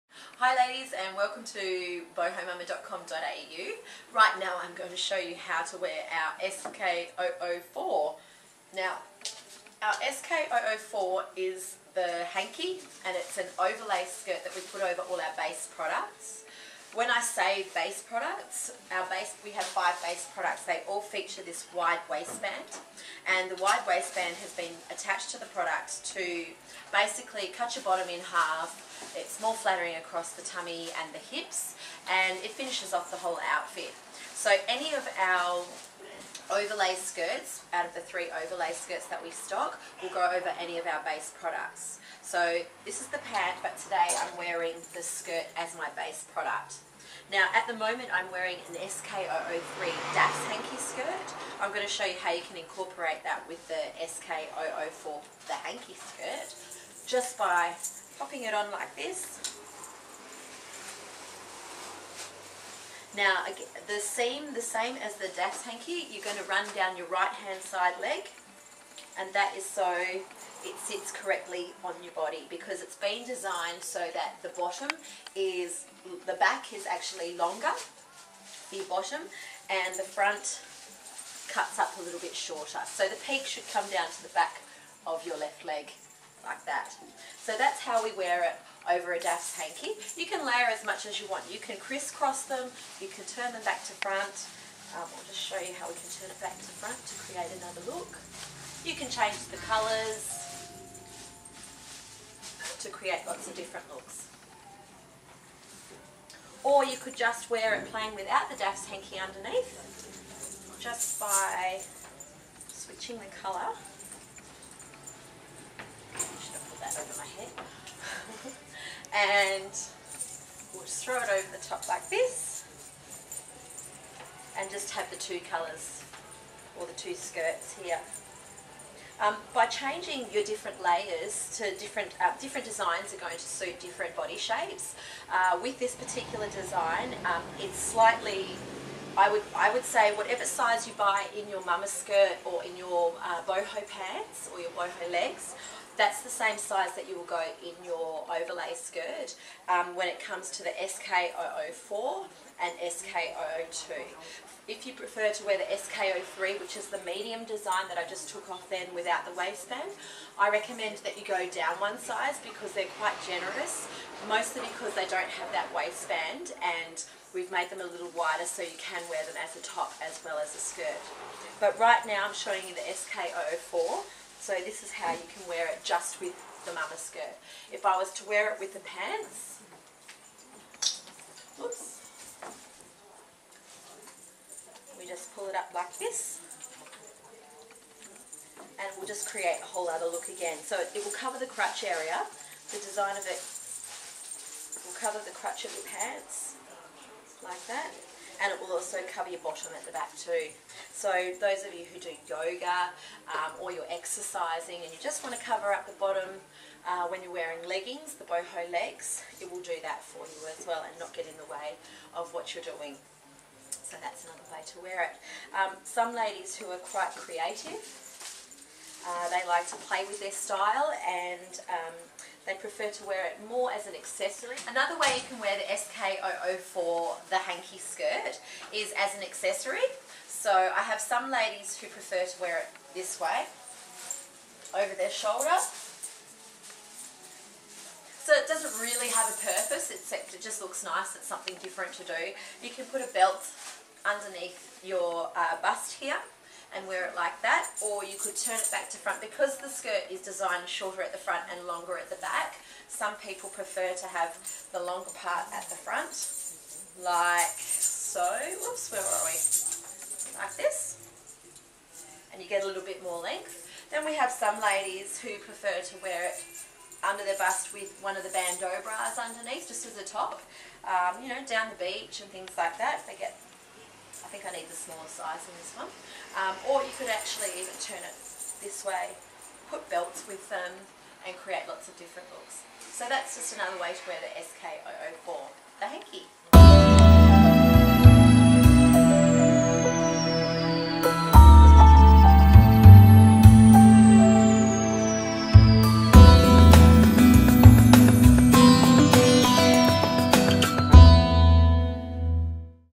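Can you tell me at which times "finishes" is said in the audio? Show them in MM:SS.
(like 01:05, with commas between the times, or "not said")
00:32.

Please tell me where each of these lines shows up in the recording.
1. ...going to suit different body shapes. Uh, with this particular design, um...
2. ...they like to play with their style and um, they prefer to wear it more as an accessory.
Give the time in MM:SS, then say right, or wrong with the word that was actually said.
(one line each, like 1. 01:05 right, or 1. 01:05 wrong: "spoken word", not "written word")
1. 02:13 right
2. 03:39 right.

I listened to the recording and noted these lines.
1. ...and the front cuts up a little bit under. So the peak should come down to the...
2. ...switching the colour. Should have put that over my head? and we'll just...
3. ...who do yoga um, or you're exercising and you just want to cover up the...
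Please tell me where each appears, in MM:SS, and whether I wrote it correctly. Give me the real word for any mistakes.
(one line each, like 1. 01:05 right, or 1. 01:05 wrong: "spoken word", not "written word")
1. 01:19 wrong: "shorter", not "under"
2. 01:52 right
3. 03:21 right.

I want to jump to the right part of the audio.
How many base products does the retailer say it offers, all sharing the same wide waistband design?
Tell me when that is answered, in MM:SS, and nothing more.
00:19.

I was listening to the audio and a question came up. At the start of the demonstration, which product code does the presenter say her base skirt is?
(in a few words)
SK003.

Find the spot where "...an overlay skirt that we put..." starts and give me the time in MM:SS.
00:13.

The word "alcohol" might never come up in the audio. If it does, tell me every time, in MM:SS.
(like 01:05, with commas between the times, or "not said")
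not said.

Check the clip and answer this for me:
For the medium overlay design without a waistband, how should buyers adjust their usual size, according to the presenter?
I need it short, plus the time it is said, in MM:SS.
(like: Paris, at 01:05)
go down one size, at 02:41.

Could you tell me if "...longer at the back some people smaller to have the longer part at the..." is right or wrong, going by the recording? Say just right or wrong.
wrong.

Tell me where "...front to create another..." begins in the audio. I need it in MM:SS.
01:36.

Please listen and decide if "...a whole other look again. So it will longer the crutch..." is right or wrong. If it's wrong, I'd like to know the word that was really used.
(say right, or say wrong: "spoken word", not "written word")
wrong: "cover", not "longer".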